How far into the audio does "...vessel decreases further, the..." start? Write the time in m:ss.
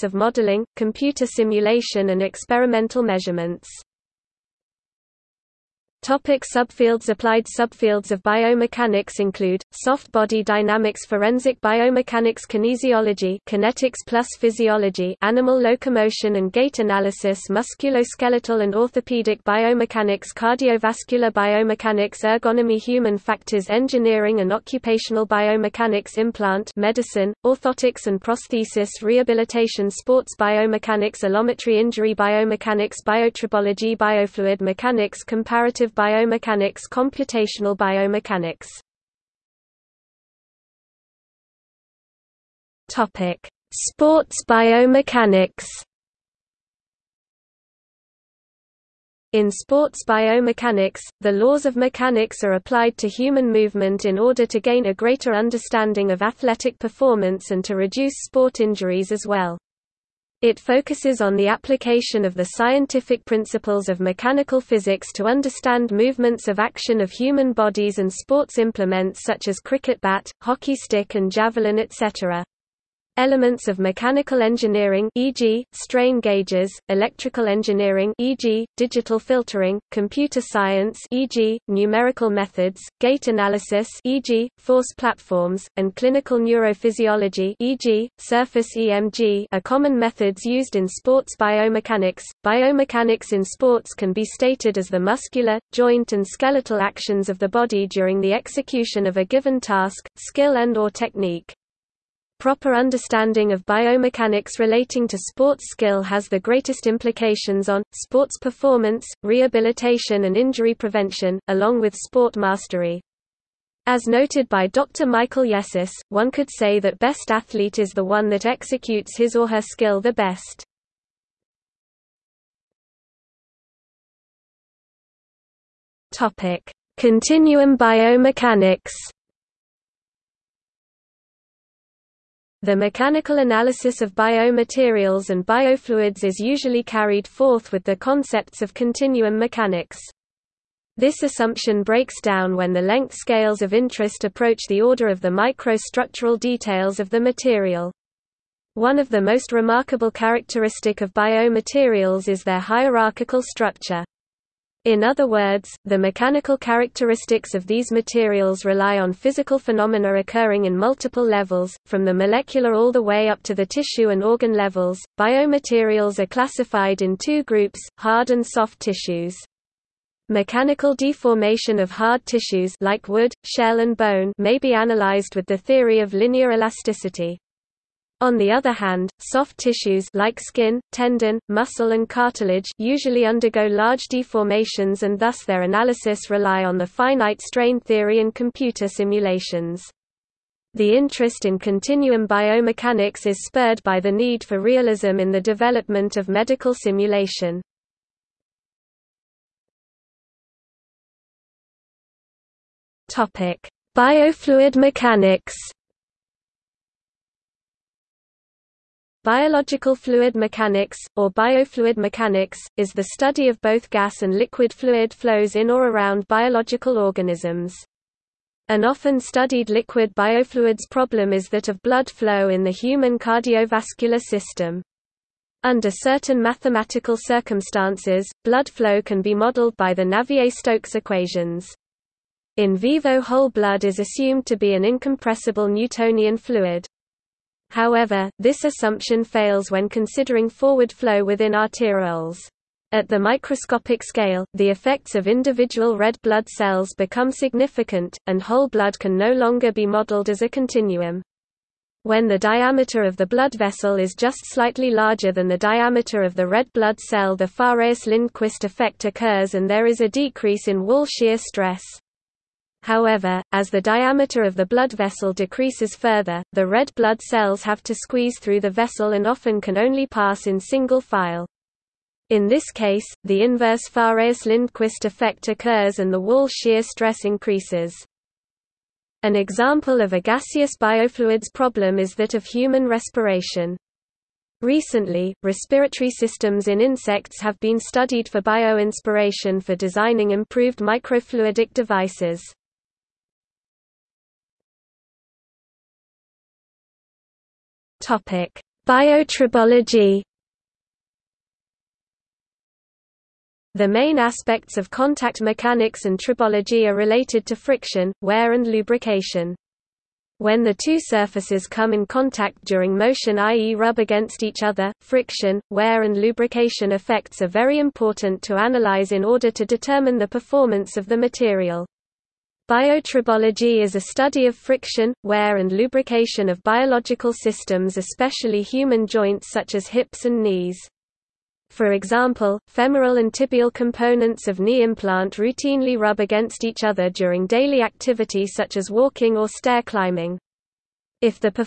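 4:24.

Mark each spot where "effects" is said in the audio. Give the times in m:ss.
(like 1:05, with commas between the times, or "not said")
4:04, 4:18, 4:35, 5:16.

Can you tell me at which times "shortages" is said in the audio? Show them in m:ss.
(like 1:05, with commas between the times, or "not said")
not said.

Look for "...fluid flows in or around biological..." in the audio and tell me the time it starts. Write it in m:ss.
3:34.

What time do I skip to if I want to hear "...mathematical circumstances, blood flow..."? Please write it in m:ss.
3:46.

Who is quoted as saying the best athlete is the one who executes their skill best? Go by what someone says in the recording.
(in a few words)
Dr. Michael Yessis.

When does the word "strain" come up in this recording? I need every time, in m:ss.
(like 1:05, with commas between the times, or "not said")
1:15, 3:07.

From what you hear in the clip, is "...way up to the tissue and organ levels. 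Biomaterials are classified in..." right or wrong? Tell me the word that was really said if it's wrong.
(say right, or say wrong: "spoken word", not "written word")
right.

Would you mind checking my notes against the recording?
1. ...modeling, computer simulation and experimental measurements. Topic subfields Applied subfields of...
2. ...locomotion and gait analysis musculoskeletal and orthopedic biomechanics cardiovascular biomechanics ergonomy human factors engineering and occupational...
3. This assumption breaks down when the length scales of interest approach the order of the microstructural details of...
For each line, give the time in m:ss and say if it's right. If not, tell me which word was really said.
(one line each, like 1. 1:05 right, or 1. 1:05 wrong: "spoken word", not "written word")
1. 0:00 right
2. 0:15 right
3. 2:20 right.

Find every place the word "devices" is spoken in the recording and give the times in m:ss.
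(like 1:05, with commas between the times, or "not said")
4:51.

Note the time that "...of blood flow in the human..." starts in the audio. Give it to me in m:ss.
3:41.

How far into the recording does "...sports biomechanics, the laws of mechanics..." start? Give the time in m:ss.
0:49.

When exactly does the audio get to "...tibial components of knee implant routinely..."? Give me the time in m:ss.
5:33.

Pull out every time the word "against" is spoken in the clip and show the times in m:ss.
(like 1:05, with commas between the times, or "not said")
5:13, 5:36.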